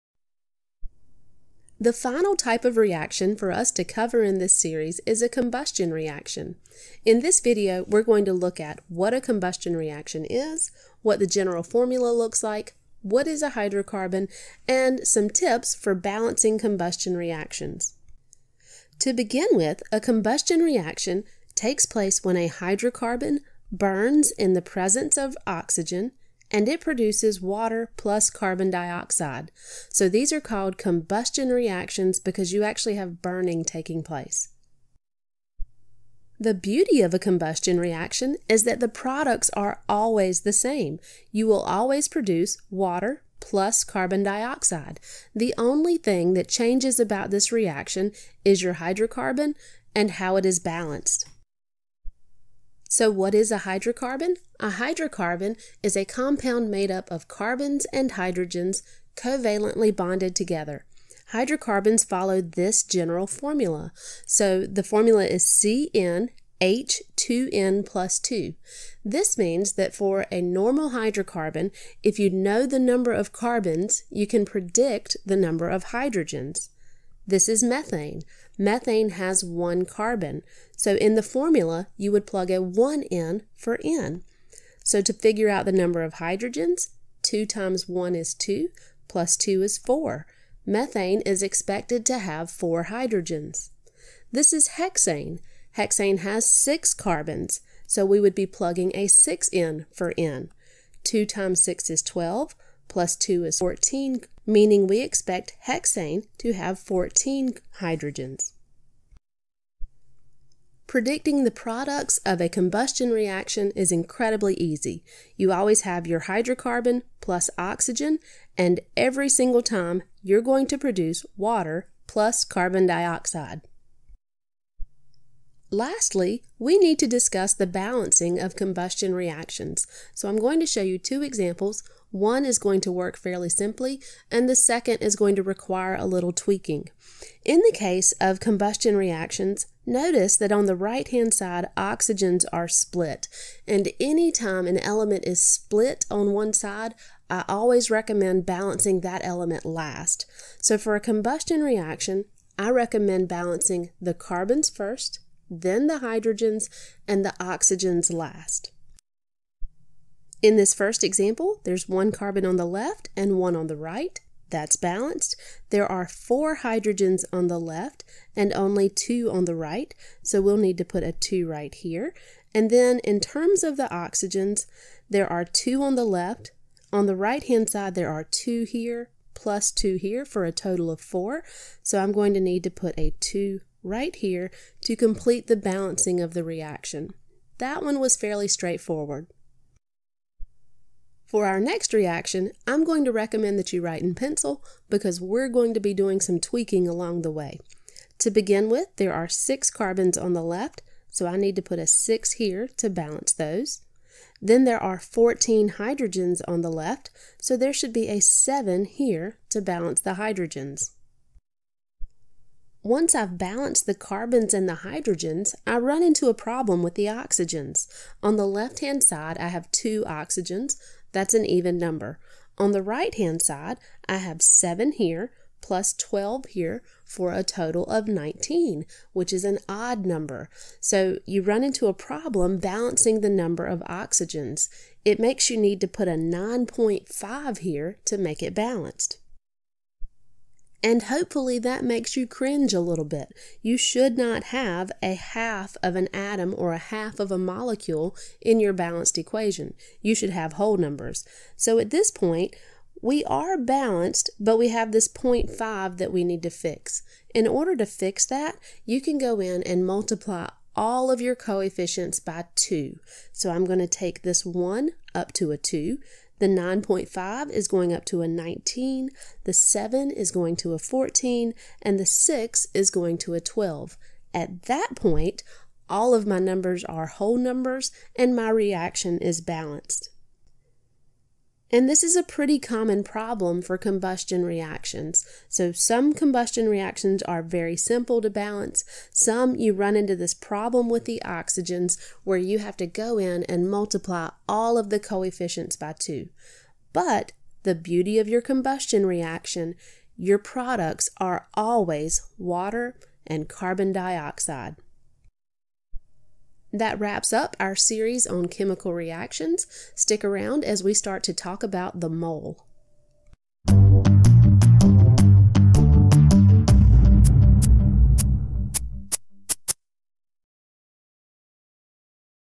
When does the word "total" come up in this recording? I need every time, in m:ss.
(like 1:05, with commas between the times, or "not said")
3:00, 3:47.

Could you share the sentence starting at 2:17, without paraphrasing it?
In the case of combustion reactions, notice that on the right-hand side, oxygens are split.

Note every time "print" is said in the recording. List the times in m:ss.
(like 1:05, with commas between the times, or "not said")
not said.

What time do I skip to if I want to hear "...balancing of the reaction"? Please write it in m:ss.
3:05.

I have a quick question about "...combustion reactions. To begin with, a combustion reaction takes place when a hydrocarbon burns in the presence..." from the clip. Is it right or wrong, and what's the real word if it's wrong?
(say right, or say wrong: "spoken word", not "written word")
right.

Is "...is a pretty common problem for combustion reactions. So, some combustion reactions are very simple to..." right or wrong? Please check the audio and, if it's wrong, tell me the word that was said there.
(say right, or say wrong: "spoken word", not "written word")
right.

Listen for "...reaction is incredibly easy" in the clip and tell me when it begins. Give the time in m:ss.
1:53.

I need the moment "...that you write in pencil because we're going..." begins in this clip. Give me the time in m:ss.
3:13.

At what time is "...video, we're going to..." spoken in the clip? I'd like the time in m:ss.
0:07.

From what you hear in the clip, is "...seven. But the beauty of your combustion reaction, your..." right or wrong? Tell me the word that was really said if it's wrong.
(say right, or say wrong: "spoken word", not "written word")
wrong: "two", not "seven".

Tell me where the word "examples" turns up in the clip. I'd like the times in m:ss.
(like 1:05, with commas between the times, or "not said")
2:11, 2:41.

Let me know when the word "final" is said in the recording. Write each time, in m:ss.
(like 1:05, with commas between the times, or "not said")
0:01.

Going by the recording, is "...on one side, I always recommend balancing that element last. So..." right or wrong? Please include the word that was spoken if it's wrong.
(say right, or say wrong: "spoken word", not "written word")
right.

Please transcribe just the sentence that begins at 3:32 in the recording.
Once I've balanced the carbons and the hydrogens, I run into a problem with the oxygens.